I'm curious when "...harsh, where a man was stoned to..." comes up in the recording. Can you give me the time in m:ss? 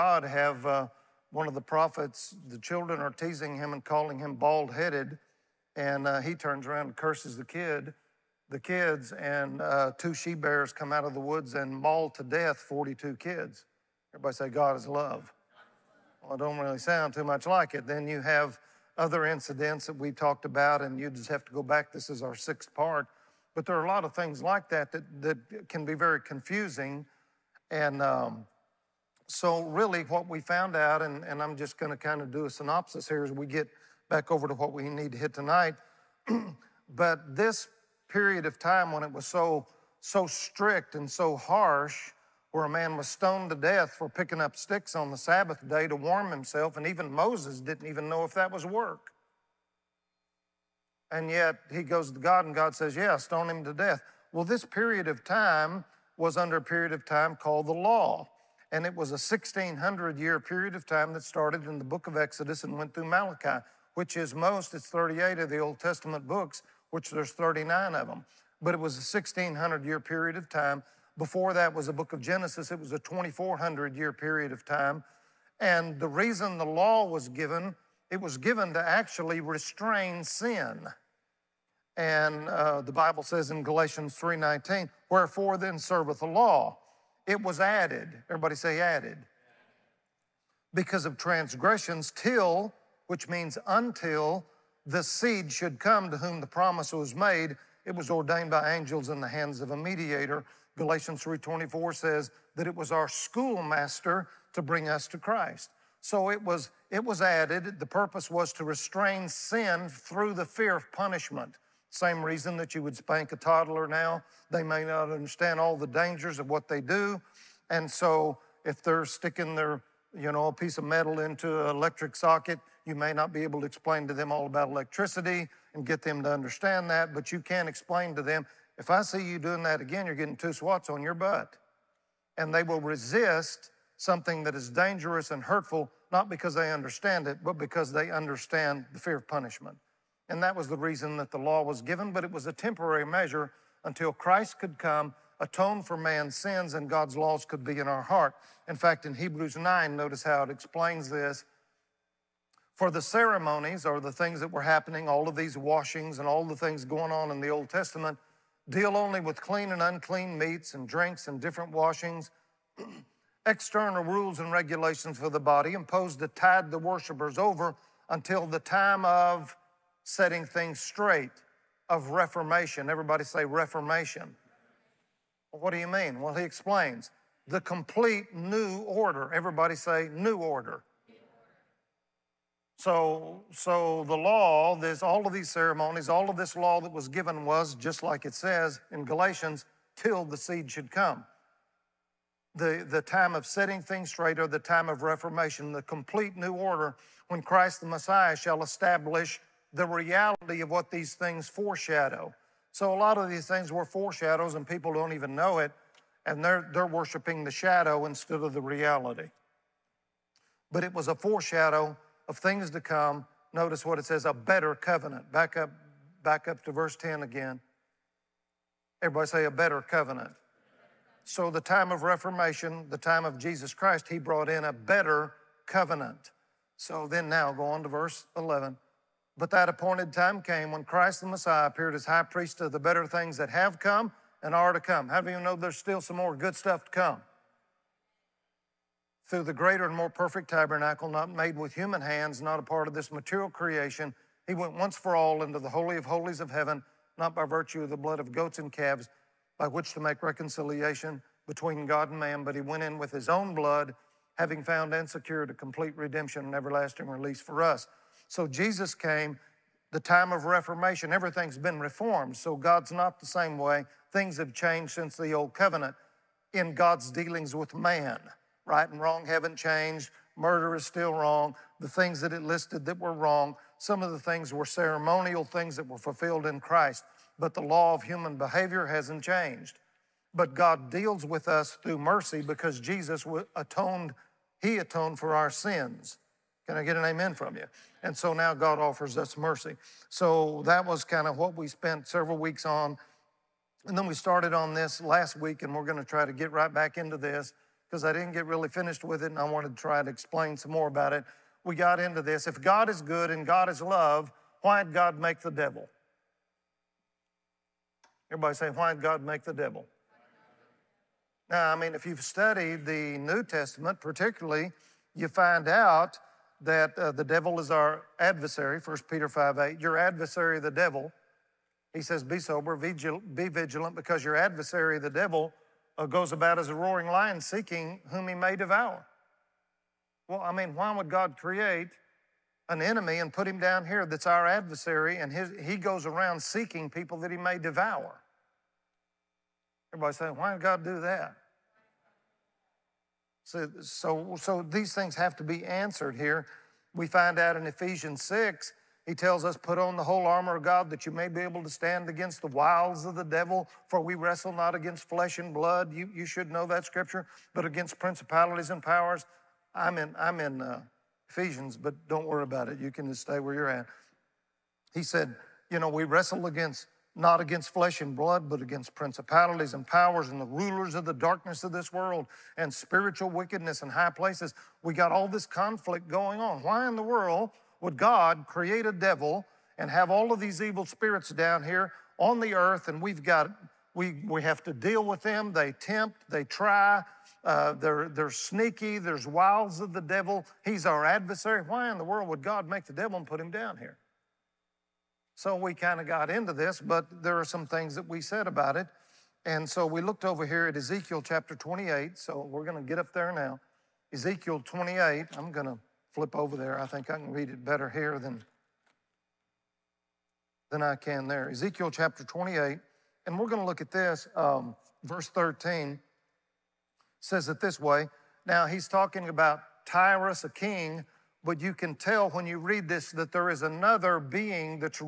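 0:41.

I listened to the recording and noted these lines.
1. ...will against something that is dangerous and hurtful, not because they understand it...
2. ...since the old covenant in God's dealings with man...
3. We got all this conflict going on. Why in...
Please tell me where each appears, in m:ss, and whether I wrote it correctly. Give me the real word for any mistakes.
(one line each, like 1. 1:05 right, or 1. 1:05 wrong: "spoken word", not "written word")
1. 2:12 wrong: "resist", not "against"
2. 4:24 right
3. 6:14 right.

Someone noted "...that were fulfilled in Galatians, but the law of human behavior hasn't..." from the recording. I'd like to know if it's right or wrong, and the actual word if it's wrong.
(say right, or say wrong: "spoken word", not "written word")
wrong: "Christ", not "Galatians".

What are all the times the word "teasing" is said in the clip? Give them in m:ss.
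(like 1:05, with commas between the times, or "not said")
0:03.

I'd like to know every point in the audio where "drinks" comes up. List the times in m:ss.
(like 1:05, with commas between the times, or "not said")
2:40.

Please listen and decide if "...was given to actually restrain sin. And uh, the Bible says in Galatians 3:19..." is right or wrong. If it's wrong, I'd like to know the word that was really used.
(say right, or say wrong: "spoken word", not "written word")
right.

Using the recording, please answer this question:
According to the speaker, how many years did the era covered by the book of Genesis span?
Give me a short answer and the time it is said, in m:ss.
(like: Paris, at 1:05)
2400 years, at 1:12.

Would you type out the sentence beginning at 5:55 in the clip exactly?
You, you should know that scripture, but against principalities and powers.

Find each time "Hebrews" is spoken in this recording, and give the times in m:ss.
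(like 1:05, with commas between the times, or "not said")
2:29.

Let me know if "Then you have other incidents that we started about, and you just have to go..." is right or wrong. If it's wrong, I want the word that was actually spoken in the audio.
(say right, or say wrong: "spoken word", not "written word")
wrong: "talked", not "started".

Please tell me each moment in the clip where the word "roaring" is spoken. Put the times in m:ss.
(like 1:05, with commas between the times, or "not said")
5:26.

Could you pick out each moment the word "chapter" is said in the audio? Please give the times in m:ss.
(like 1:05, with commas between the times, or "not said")
6:41, 6:51.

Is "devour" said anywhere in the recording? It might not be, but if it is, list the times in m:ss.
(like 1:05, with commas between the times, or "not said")
5:28, 5:37.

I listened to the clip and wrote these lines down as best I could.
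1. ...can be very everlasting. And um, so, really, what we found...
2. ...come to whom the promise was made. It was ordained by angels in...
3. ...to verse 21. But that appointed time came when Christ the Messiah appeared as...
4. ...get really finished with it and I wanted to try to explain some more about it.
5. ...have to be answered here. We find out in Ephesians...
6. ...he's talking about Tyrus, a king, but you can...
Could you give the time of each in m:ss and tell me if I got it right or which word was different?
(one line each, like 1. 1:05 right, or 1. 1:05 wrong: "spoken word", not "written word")
1. 0:25 wrong: "confusing", not "everlasting"
2. 1:35 right
3. 3:47 wrong: "11", not "21"
4. 4:58 right
5. 5:45 right
6. 6:58 right.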